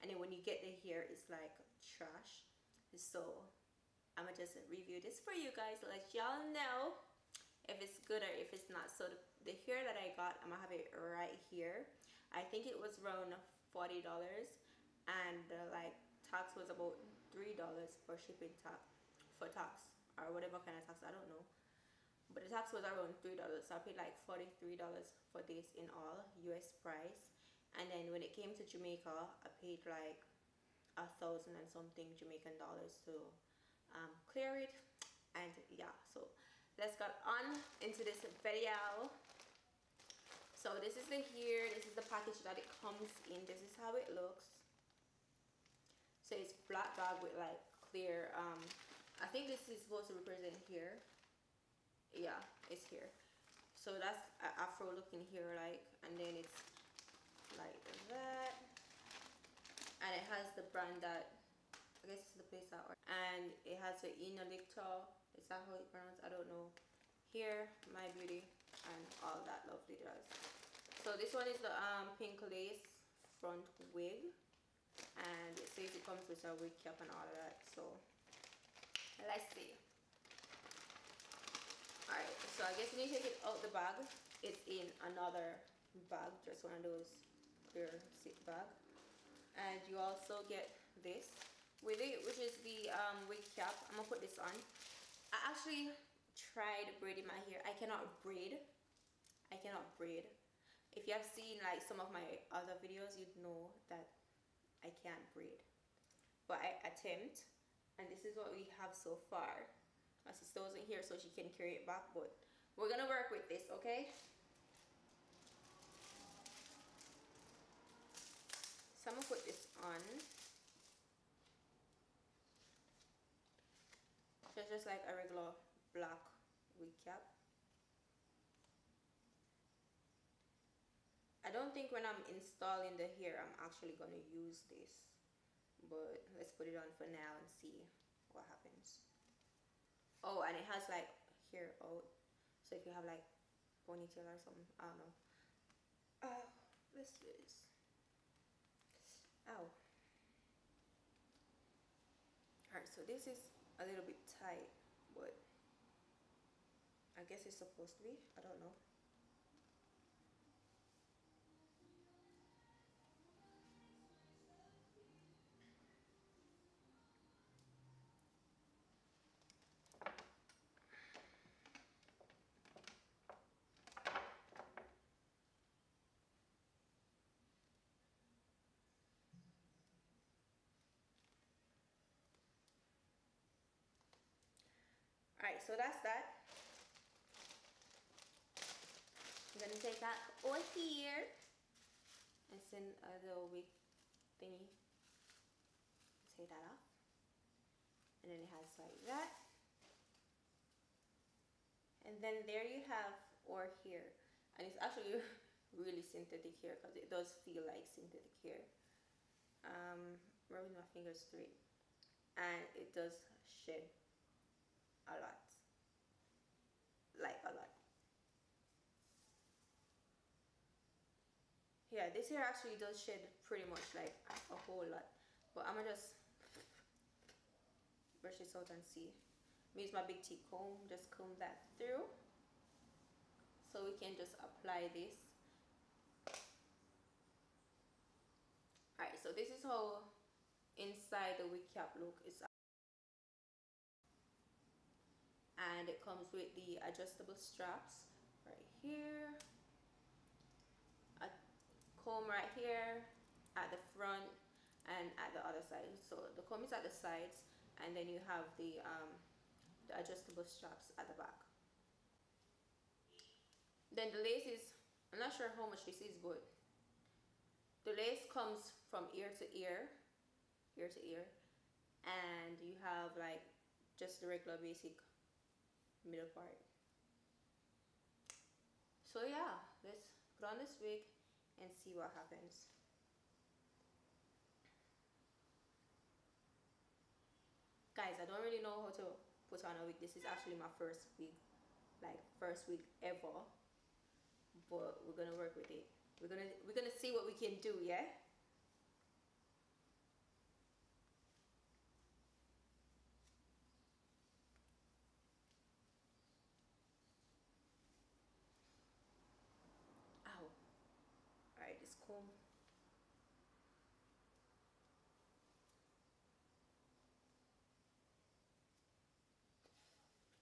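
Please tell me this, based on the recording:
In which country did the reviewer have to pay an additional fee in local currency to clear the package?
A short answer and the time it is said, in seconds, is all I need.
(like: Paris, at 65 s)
Jamaica, at 28 s.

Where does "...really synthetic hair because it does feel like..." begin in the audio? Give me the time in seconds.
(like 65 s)
205 s.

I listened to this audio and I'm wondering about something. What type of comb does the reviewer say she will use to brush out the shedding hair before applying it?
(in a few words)
Big T comb.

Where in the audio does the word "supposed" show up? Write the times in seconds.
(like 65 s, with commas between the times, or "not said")
49 s, 157 s.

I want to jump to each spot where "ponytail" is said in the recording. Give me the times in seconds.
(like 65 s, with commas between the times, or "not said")
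143 s.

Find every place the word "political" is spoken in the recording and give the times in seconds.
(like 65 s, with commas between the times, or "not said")
not said.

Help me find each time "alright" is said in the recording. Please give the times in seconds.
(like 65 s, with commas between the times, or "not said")
152 s, 238 s.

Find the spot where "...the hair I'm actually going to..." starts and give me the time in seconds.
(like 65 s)
132 s.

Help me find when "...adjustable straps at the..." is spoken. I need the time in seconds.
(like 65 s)
259 s.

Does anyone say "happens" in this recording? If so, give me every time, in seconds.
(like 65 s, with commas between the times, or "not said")
138 s, 282 s.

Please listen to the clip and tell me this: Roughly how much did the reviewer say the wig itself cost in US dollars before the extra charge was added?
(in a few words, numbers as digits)
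$40.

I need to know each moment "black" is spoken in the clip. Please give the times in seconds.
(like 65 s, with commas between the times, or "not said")
46 s, 125 s.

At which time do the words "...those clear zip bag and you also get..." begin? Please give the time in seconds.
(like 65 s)
86 s.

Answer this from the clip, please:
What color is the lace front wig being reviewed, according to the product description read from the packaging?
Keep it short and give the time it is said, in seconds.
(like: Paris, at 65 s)
Pink, at 72 s.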